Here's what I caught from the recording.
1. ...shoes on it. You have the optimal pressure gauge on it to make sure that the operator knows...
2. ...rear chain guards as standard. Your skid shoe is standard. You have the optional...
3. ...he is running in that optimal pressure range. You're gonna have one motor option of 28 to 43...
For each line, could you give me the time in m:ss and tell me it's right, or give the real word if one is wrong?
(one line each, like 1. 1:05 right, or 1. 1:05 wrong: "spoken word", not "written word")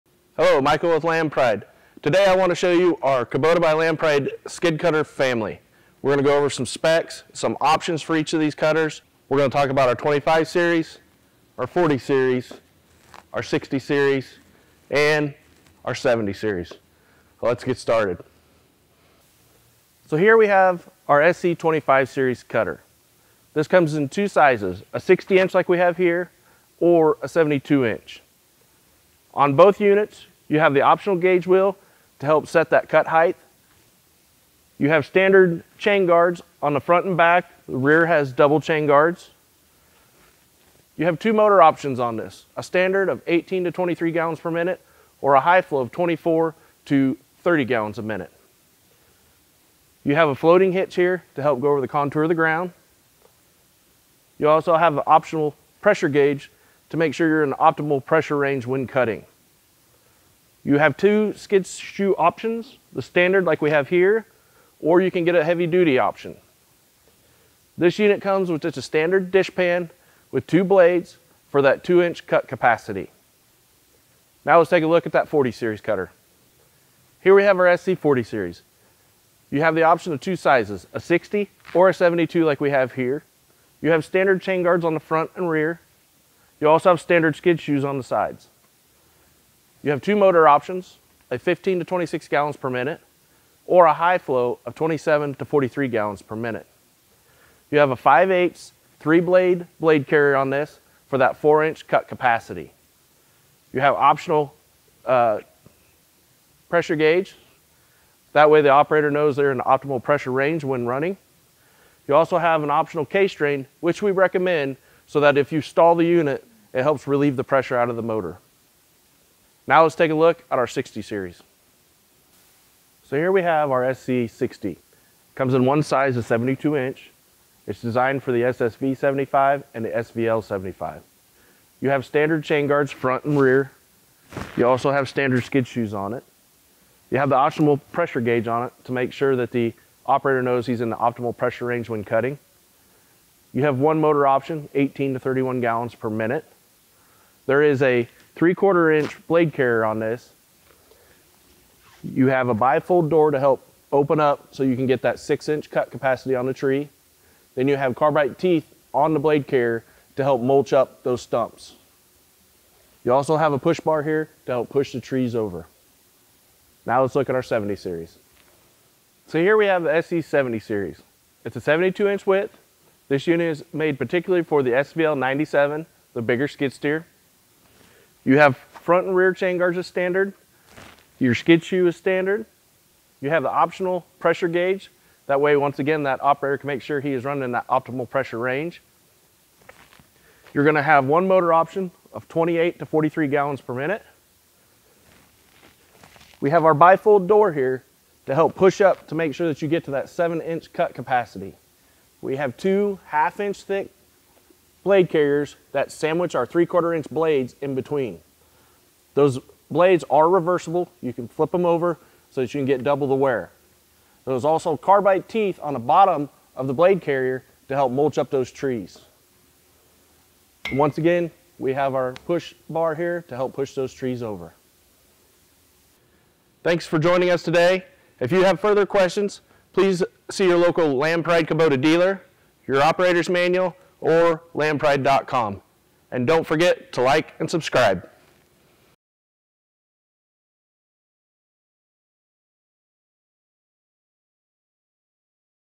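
1. 2:15 right
2. 2:59 right
3. 3:06 right.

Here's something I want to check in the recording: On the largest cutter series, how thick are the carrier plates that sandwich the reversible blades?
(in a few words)
1/2 inch.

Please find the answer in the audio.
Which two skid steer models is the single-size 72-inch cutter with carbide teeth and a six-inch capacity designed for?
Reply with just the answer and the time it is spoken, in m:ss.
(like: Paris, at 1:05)
SSV75 and SVL75, at 2:08.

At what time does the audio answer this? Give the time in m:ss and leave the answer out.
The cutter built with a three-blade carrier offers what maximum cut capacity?
1:41.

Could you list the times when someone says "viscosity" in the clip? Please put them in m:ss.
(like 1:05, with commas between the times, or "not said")
not said.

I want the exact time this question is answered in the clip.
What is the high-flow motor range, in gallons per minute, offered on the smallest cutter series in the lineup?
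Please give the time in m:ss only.
0:45.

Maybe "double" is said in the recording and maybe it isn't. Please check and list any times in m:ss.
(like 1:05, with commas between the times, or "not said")
0:38, 3:32.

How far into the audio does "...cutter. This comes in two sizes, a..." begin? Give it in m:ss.
0:22.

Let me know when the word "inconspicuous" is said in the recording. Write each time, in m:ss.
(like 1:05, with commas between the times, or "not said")
not said.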